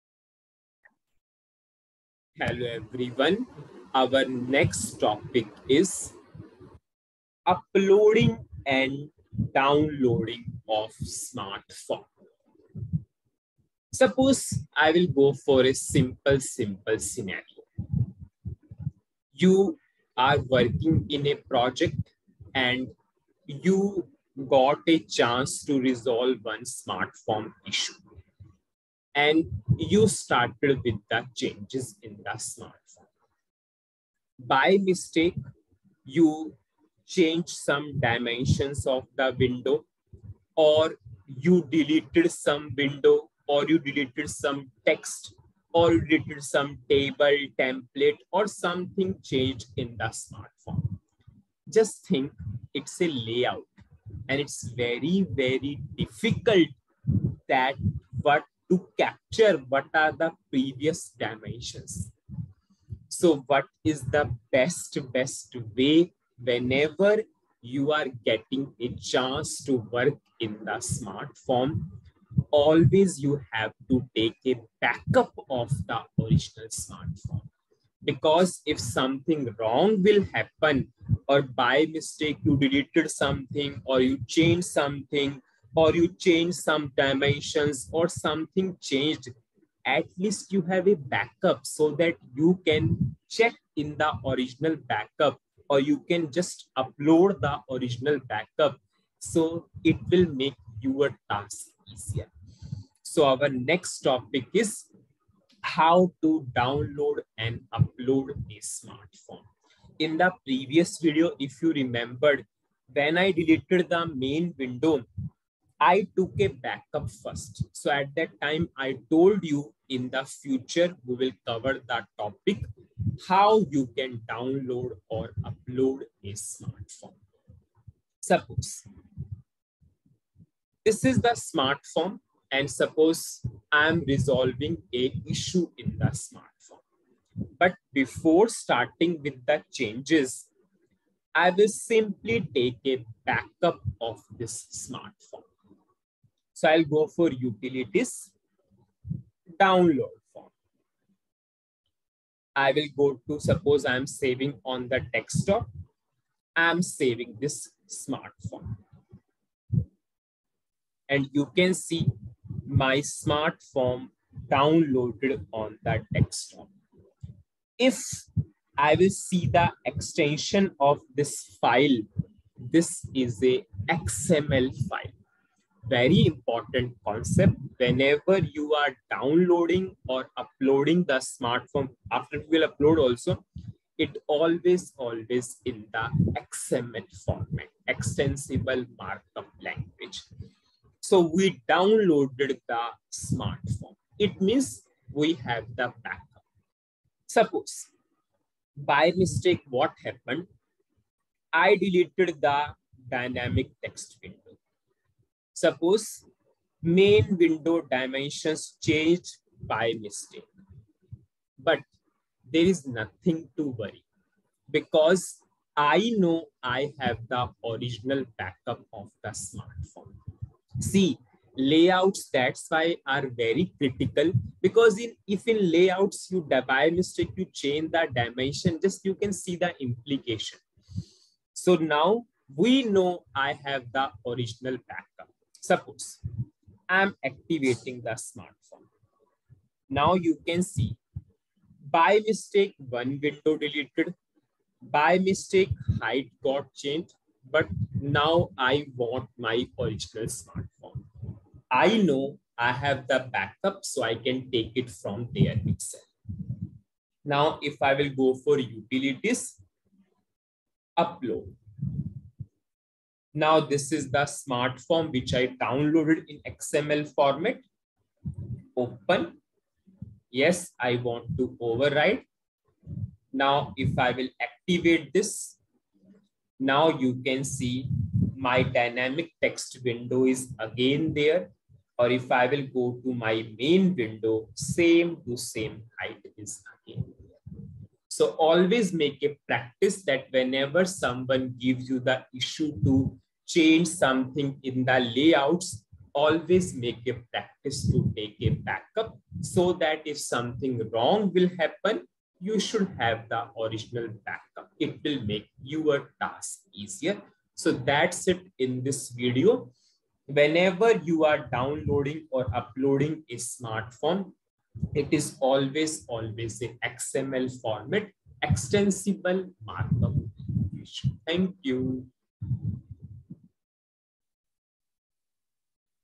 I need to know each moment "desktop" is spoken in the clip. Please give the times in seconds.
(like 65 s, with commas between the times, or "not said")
155 s, 166 s.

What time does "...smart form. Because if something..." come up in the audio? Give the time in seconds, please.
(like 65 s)
76 s.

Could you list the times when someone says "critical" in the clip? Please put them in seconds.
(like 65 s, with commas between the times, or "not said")
223 s.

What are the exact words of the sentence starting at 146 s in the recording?
So I'll go for utilities download form.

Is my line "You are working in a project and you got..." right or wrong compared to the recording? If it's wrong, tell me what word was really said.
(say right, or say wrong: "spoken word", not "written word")
right.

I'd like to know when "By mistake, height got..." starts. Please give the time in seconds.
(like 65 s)
244 s.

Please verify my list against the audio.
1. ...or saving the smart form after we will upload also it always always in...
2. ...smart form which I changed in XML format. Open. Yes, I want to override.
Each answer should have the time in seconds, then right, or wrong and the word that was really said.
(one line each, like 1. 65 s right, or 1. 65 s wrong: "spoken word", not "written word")
1. 180 s wrong: "uploading", not "saving"
2. 264 s wrong: "downloaded", not "changed".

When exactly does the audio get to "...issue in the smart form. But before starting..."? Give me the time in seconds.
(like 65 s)
135 s.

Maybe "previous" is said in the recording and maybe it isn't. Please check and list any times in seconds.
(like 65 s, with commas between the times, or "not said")
60 s, 110 s.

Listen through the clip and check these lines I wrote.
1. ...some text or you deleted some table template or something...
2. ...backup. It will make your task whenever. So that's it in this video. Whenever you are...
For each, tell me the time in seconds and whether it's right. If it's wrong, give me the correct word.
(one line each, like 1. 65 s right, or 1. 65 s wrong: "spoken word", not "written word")
1. 44 s right
2. 304 s wrong: "easier", not "whenever".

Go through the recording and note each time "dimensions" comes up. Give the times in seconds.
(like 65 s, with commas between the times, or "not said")
37 s, 61 s, 86 s, 207 s, 228 s.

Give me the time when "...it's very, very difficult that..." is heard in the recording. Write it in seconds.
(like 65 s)
54 s.